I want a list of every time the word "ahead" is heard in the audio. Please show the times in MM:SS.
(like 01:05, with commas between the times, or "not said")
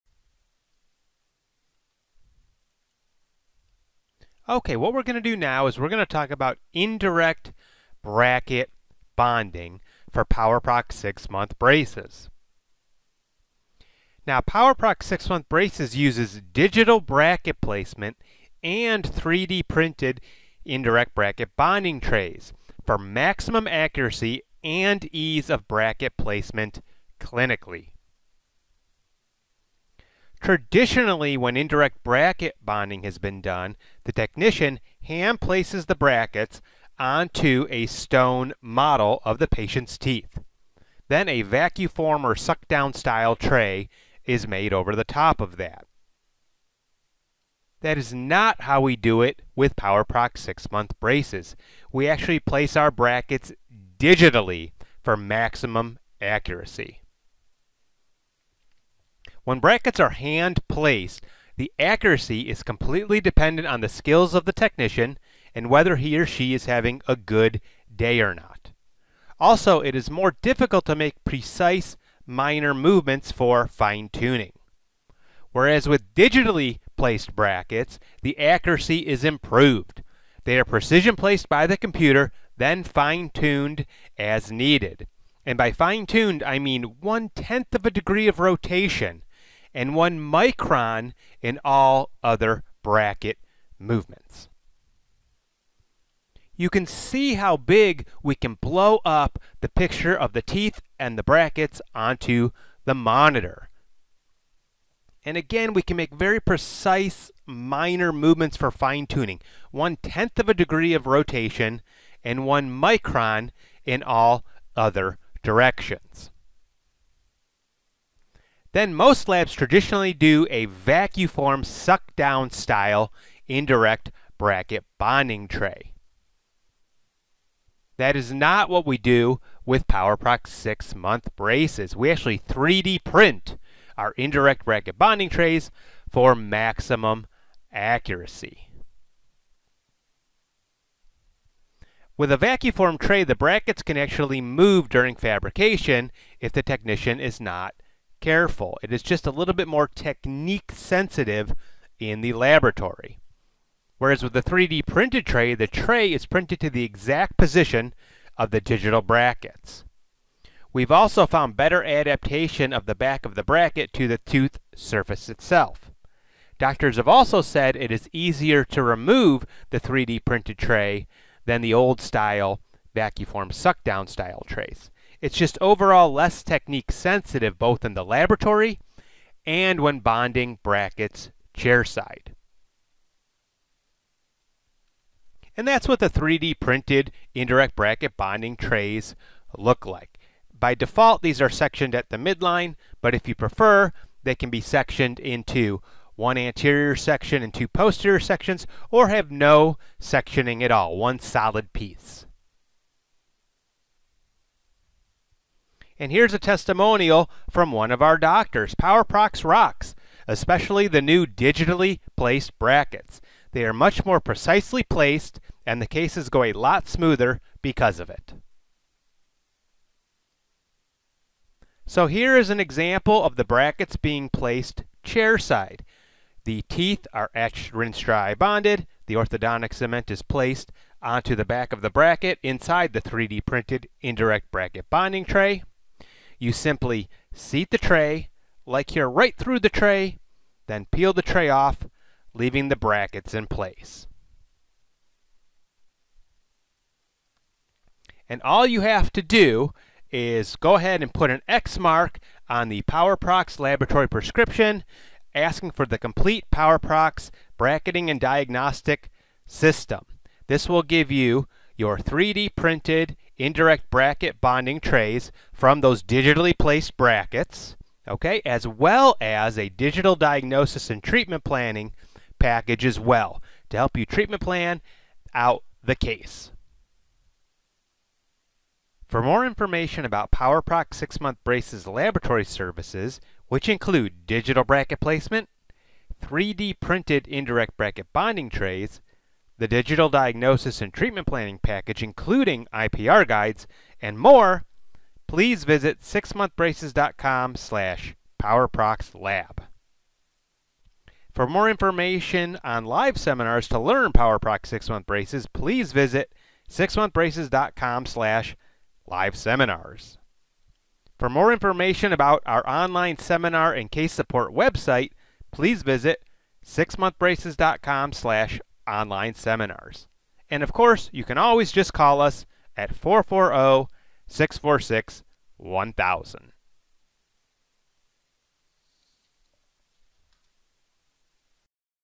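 04:10.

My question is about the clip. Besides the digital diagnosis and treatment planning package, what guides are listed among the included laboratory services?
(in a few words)
IPR guides.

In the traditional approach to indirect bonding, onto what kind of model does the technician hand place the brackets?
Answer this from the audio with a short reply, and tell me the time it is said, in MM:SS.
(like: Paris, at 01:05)
stone model, at 00:37.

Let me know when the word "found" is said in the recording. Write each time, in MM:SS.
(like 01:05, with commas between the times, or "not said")
02:41.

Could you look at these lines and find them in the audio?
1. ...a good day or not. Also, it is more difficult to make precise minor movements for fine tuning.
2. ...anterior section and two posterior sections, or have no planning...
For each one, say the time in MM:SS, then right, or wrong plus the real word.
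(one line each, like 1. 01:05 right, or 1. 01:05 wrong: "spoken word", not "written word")
1. 01:07 right
2. 03:16 wrong: "sectioning", not "planning".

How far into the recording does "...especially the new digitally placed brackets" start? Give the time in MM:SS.
03:30.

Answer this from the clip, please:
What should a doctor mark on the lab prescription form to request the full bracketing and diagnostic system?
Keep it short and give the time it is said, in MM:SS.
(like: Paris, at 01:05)
an X, at 04:11.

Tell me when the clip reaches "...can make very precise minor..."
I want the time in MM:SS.
01:45.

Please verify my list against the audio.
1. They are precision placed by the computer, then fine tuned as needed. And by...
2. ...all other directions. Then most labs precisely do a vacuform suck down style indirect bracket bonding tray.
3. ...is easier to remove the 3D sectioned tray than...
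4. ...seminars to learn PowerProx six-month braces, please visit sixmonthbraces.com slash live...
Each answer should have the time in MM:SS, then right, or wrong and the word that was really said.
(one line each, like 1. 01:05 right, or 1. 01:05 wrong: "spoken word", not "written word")
1. 01:20 right
2. 01:54 wrong: "traditionally", not "precisely"
3. 02:47 wrong: "printed", not "sectioned"
4. 05:03 right.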